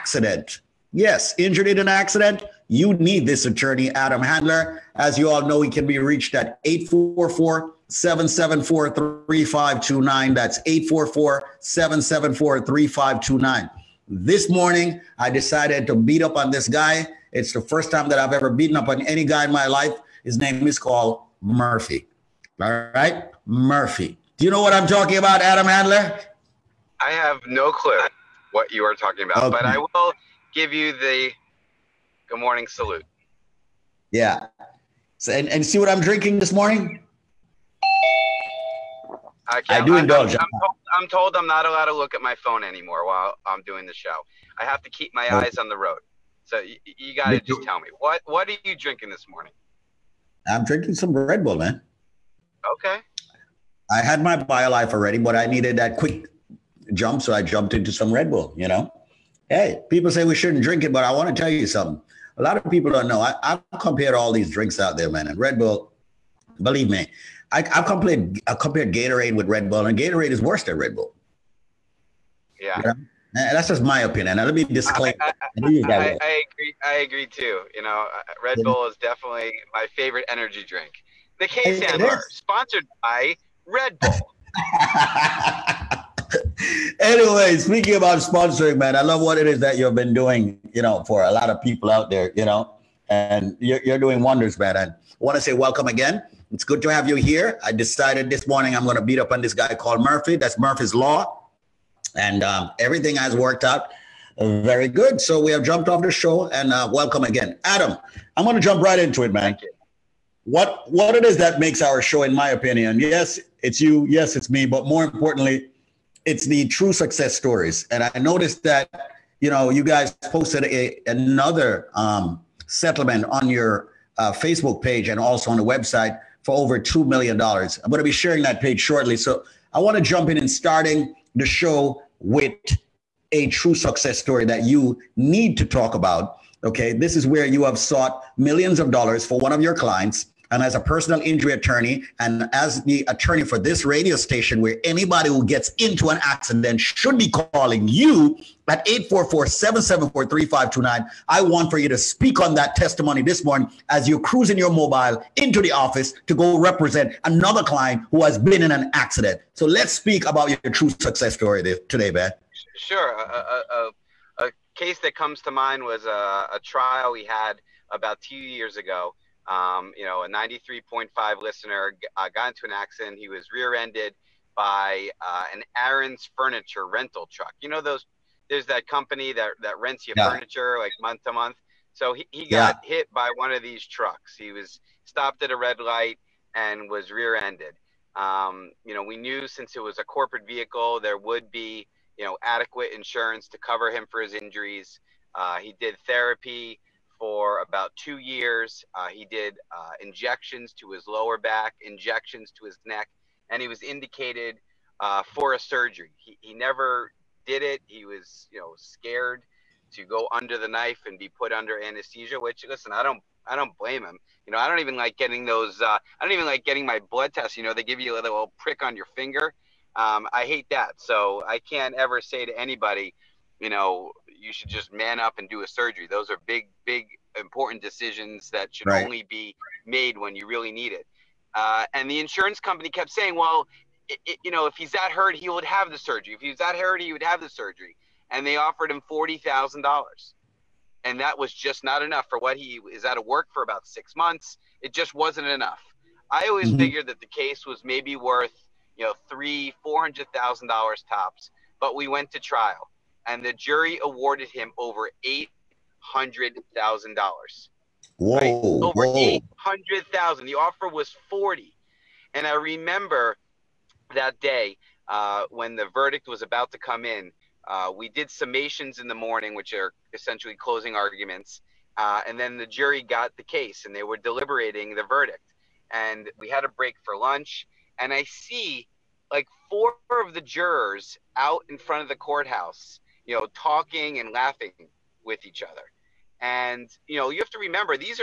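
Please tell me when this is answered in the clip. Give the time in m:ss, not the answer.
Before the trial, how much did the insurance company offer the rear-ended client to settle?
3:58.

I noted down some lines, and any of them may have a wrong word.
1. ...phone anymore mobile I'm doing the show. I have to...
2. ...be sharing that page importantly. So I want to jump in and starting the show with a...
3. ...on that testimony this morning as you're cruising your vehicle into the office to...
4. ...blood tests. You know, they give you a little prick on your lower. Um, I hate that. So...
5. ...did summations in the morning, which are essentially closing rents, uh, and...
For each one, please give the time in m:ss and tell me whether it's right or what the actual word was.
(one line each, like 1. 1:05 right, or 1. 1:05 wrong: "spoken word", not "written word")
1. 0:42 wrong: "while", not "mobile"
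2. 2:08 wrong: "shortly", not "importantly"
3. 2:32 wrong: "mobile", not "vehicle"
4. 3:37 wrong: "finger", not "lower"
5. 4:28 wrong: "arguments", not "rents".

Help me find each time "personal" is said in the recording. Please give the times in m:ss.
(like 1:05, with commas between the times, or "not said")
2:20.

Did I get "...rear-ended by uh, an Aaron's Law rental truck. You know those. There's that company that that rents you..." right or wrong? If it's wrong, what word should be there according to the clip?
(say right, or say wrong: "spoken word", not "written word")
wrong: "Furniture", not "Law".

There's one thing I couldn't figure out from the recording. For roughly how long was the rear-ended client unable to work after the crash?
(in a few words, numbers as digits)
6 months.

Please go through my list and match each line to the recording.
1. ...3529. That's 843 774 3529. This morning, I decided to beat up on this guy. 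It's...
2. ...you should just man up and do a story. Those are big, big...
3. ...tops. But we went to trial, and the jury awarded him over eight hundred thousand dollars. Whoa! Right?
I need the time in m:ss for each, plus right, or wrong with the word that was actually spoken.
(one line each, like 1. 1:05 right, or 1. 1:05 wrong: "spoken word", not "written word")
1. 0:09 wrong: "844", not "843"
2. 3:44 wrong: "surgery", not "story"
3. 4:11 right.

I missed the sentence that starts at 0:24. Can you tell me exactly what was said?
Do you know what I'm talking about, Adam Handler?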